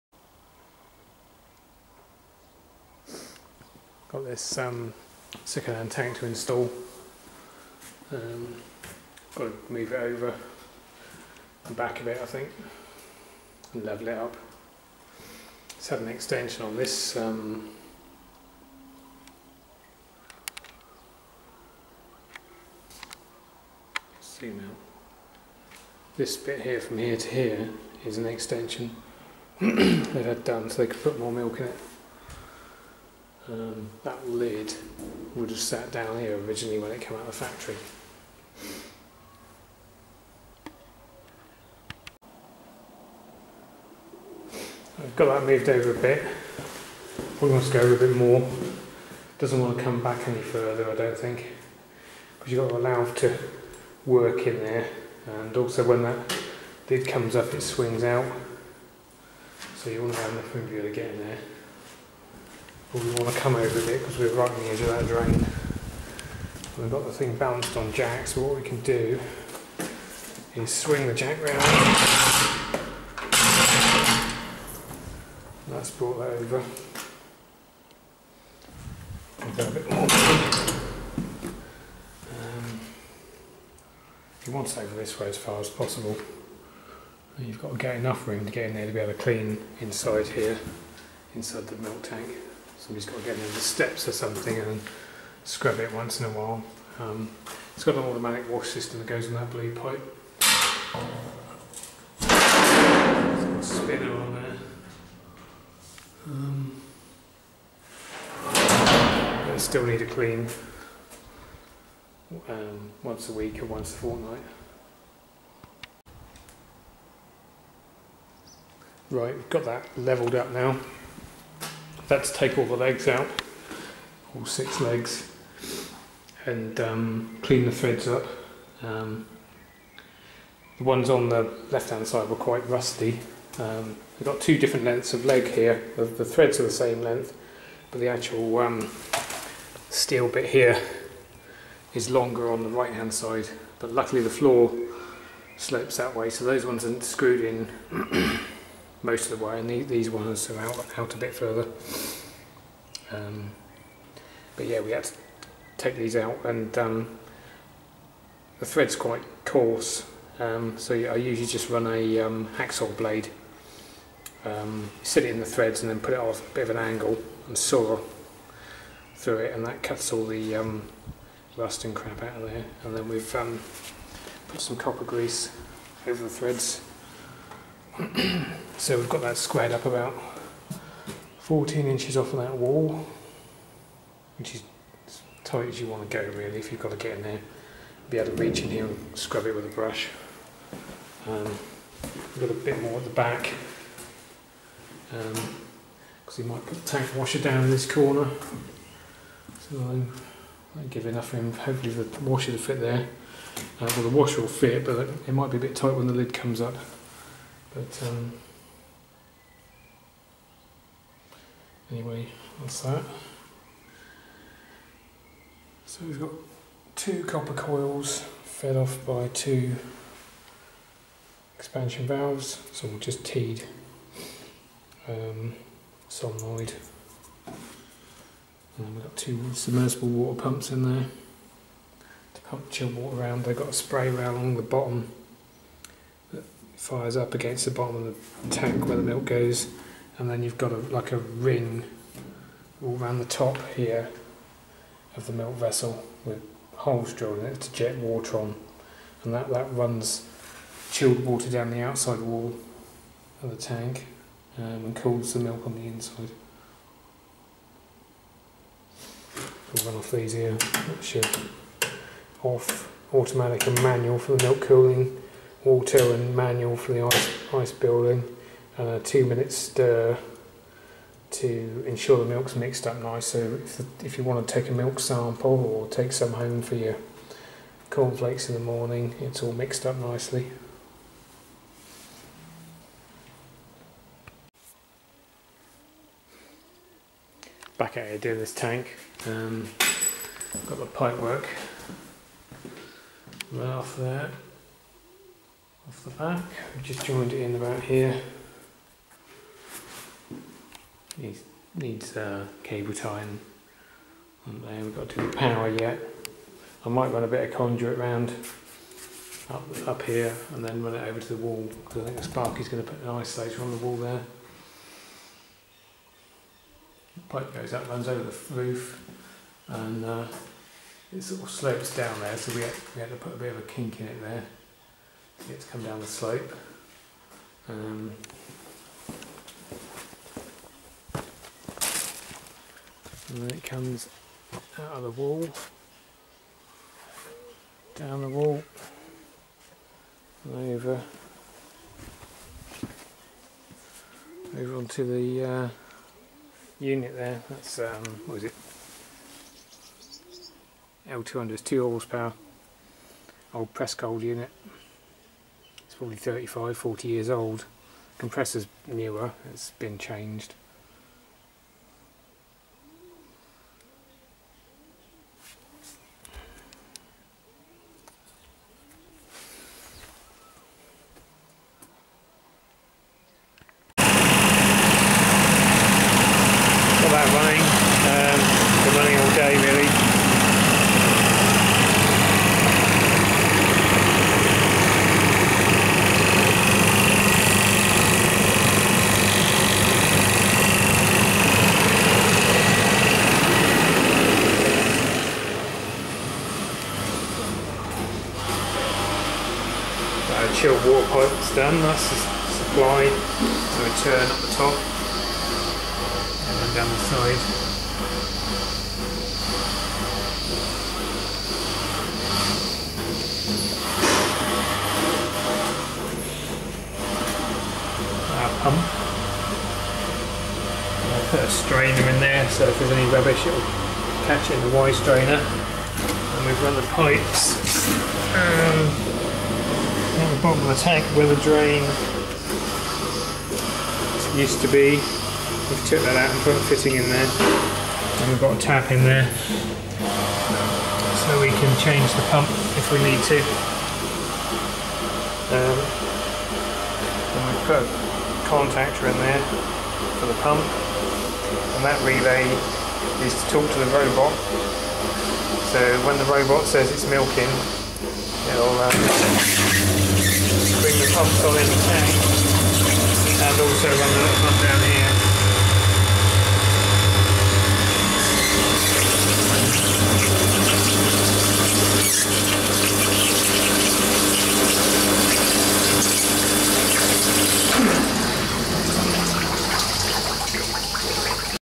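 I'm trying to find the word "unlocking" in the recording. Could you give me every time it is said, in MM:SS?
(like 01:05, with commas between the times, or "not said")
not said.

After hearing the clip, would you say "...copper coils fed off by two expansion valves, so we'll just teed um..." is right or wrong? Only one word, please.
right.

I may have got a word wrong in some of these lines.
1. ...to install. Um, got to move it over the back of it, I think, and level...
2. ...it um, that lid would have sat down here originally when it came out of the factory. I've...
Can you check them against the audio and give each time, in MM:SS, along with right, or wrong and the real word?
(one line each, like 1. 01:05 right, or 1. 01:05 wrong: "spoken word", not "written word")
1. 00:06 right
2. 00:31 right.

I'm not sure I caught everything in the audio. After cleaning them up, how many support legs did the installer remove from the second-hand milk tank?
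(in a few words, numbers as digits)
6.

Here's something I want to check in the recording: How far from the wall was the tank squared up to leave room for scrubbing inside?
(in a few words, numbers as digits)
14 inches.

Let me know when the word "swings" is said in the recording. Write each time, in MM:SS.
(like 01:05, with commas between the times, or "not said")
00:57, 01:10.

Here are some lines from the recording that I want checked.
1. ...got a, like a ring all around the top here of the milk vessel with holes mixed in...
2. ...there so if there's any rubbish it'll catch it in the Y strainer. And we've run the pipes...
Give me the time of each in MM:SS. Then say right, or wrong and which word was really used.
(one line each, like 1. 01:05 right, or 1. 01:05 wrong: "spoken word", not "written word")
1. 04:00 wrong: "drilled", not "mixed"
2. 07:02 right.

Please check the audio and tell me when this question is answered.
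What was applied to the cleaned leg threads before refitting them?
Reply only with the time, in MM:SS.
02:54.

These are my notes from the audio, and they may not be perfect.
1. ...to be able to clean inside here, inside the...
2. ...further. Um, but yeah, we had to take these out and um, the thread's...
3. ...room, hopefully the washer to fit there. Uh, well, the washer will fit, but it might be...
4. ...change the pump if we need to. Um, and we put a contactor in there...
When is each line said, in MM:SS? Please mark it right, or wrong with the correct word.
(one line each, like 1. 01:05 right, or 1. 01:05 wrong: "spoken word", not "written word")
1. 01:28 right
2. 02:31 right
3. 03:21 right
4. 07:21 right.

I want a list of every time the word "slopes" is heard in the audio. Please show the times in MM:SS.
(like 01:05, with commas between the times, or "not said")
02:25, 05:21, 05:26.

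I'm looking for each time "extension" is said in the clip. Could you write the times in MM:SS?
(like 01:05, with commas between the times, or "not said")
00:16, 00:28.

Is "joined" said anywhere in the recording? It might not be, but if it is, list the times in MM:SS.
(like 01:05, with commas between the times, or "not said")
04:57.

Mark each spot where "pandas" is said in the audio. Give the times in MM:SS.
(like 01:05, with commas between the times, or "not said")
not said.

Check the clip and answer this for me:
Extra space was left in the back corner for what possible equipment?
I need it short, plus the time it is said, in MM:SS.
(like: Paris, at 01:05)
Tank washer, at 03:16.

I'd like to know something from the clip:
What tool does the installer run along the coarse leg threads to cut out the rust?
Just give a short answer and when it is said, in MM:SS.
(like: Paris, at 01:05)
Hacksaw blade, at 02:42.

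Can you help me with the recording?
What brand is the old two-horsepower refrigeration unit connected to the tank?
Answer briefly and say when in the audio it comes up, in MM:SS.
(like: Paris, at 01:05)
Prestcold, at 05:53.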